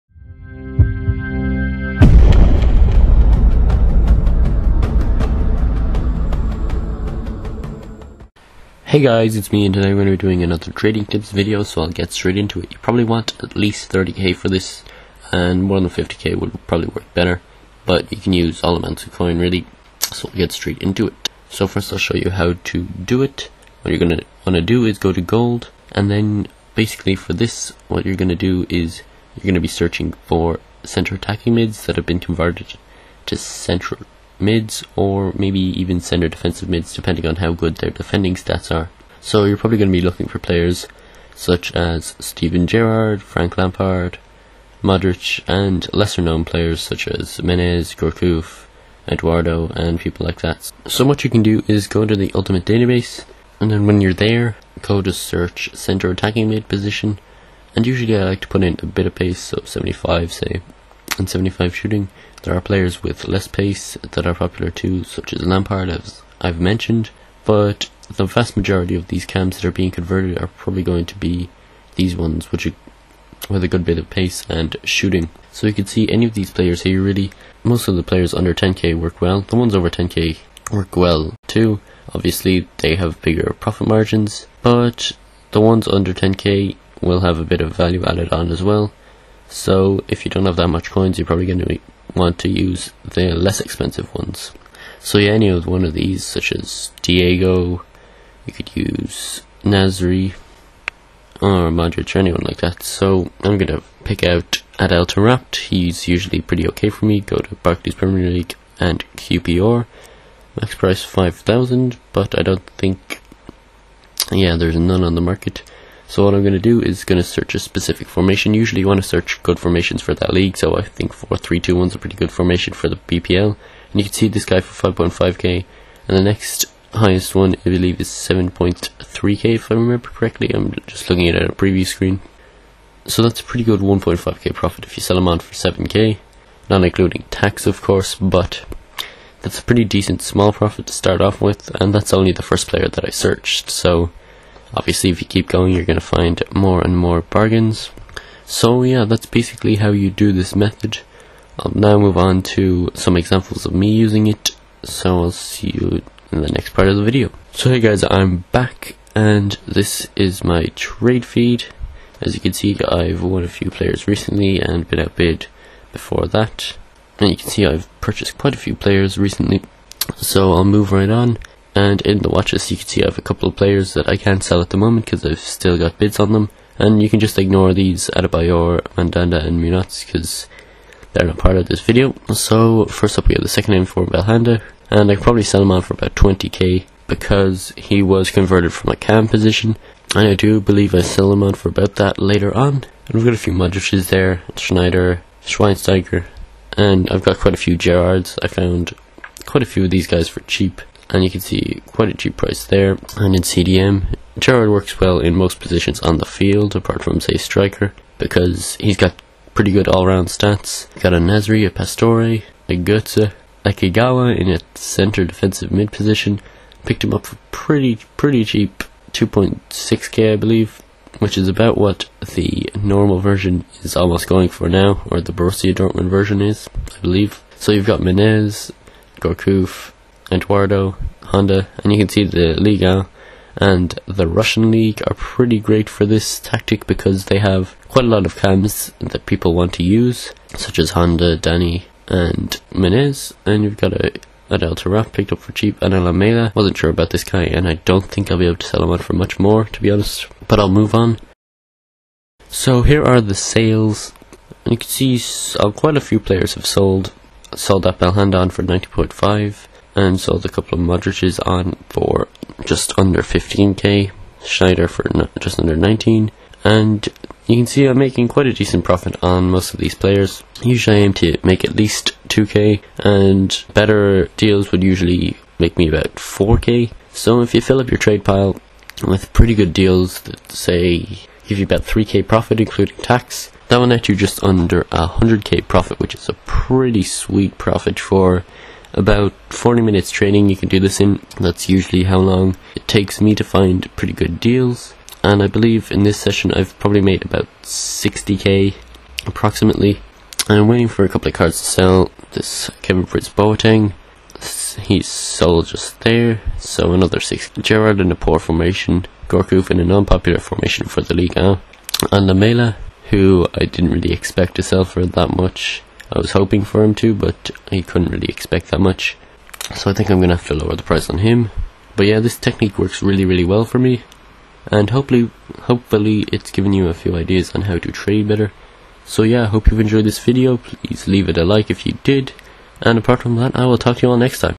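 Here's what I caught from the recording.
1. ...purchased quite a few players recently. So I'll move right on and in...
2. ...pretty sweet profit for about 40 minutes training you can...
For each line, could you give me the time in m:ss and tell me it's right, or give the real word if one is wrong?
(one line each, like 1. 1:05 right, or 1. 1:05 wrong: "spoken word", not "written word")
1. 2:47 right
2. 4:46 right.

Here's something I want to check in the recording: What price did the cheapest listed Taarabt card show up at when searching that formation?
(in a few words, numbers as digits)
5.5k.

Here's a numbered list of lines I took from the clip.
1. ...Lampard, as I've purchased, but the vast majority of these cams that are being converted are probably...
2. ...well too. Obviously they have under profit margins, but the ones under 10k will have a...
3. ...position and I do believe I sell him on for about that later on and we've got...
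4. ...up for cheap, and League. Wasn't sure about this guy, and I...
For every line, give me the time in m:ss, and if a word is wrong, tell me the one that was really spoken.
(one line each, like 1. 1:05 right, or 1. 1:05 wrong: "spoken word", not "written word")
1. 1:05 wrong: "mentioned", not "purchased"
2. 1:20 wrong: "bigger", not "under"
3. 3:09 right
4. 4:05 wrong: "Alameda", not "League".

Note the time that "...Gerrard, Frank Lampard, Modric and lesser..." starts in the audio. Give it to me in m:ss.
0:42.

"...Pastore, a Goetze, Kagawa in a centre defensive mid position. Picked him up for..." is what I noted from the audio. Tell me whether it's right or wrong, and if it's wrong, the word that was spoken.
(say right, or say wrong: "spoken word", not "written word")
right.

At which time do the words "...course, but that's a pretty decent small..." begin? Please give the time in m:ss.
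2:17.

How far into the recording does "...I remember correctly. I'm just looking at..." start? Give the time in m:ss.
2:09.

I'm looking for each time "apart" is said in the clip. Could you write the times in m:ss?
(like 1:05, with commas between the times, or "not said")
3:26, 5:32.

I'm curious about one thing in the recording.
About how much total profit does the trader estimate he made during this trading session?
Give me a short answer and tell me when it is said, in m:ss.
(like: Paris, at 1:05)
60k, at 4:57.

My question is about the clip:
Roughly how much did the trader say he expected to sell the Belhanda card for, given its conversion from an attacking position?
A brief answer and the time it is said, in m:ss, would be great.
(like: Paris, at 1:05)
20k, at 3:06.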